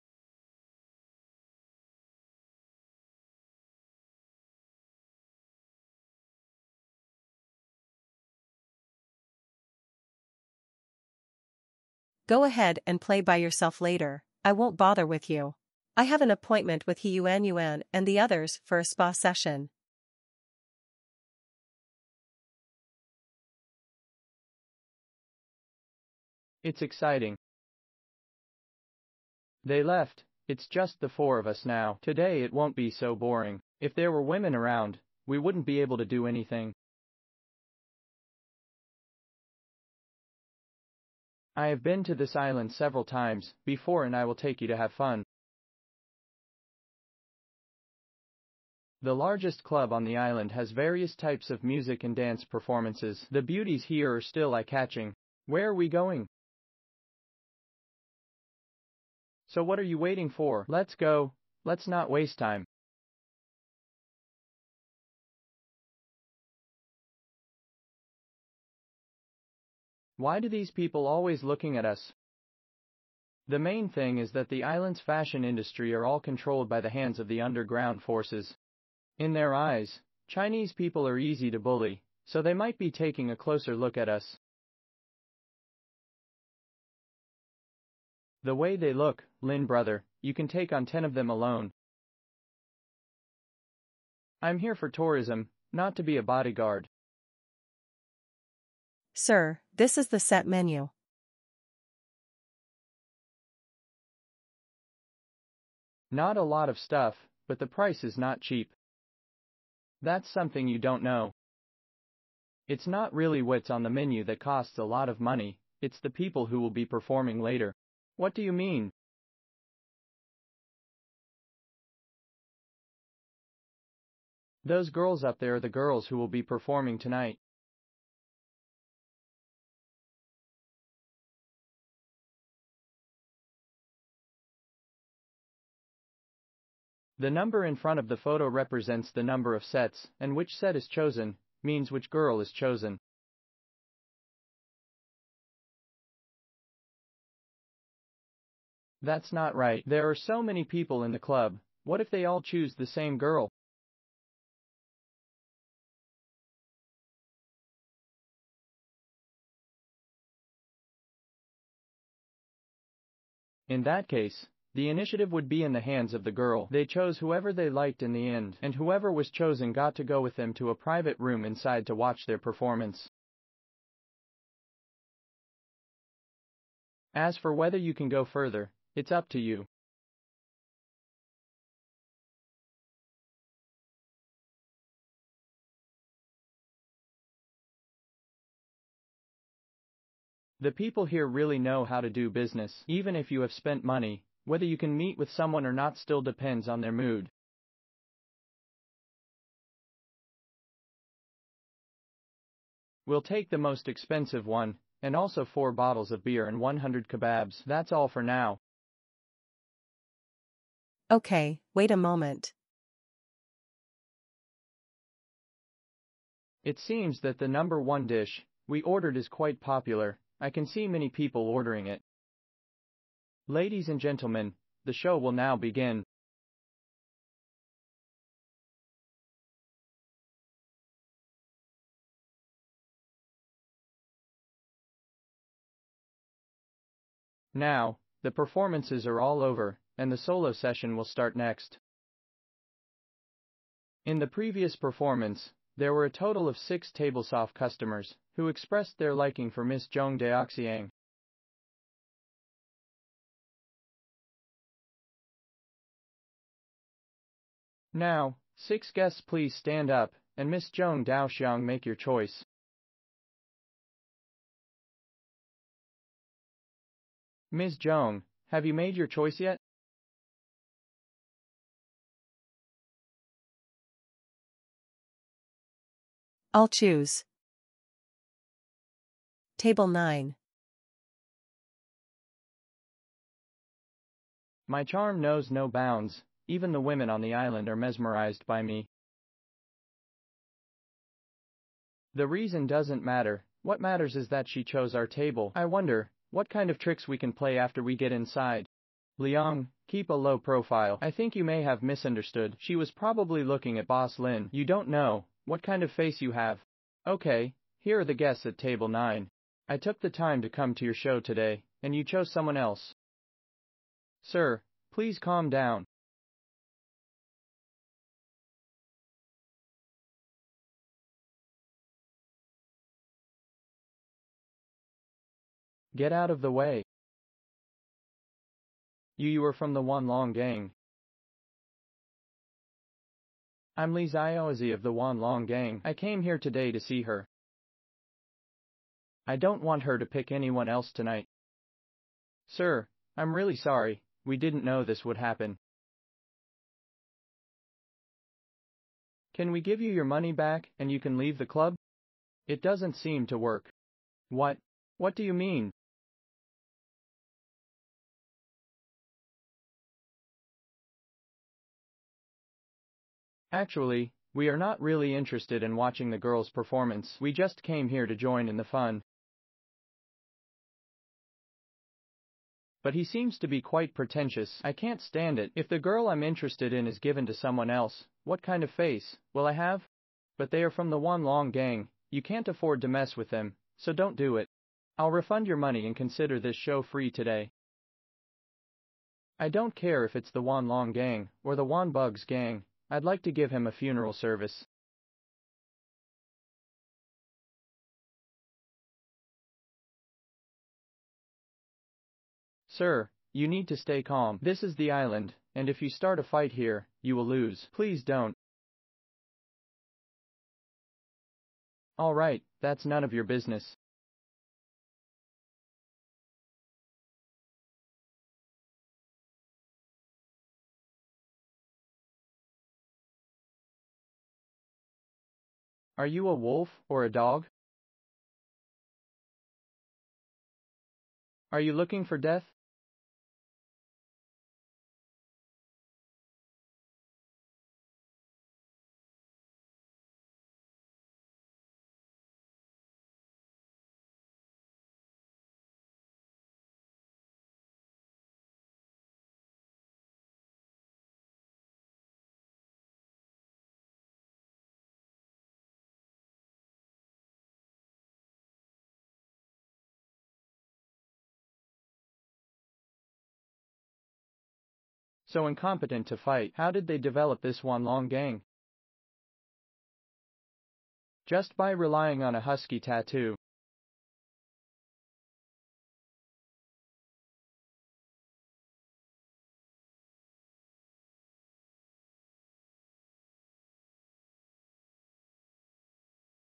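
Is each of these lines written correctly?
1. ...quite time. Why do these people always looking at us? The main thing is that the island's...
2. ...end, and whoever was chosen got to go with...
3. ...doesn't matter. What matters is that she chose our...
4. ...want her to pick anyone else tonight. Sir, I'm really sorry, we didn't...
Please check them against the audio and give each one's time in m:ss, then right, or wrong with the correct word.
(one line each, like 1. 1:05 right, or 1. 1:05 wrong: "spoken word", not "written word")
1. 1:02 wrong: "waste", not "quite"
2. 2:48 right
3. 4:52 right
4. 5:39 right.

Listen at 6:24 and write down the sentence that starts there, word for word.
I'll refund your money and consider this show free today.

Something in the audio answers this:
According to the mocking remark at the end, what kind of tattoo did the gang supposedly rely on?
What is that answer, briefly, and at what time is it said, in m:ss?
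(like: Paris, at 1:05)
Husky tattoo, at 7:52.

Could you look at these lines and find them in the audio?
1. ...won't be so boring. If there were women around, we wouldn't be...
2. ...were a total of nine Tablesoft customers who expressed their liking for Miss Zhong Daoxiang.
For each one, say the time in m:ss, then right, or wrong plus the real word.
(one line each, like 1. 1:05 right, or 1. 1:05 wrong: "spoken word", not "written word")
1. 0:32 right
2. 4:05 wrong: "six", not "nine".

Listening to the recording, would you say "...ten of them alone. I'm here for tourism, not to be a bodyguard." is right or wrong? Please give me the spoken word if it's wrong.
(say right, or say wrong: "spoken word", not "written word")
right.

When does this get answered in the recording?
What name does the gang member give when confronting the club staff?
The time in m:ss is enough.
5:33.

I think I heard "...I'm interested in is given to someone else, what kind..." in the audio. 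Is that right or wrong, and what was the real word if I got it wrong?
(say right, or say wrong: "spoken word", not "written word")
right.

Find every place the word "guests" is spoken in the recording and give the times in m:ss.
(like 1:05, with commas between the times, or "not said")
4:18, 5:08.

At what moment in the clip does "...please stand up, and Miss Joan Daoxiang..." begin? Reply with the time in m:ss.
4:19.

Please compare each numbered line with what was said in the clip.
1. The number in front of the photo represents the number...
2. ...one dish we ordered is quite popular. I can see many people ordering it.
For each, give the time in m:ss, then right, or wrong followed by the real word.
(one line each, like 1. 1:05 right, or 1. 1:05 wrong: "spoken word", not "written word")
1. 2:17 right
2. 3:37 right.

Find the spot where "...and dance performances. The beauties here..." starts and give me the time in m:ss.
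0:52.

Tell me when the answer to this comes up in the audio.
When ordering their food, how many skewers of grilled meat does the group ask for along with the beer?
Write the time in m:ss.
3:26.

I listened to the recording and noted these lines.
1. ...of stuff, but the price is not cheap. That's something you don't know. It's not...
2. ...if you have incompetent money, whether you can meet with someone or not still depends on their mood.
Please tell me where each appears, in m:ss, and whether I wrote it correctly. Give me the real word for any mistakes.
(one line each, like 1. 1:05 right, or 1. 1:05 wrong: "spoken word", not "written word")
1. 1:46 right
2. 3:13 wrong: "spent", not "incompetent".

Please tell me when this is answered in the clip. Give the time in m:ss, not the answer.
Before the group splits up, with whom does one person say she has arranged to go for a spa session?
0:16.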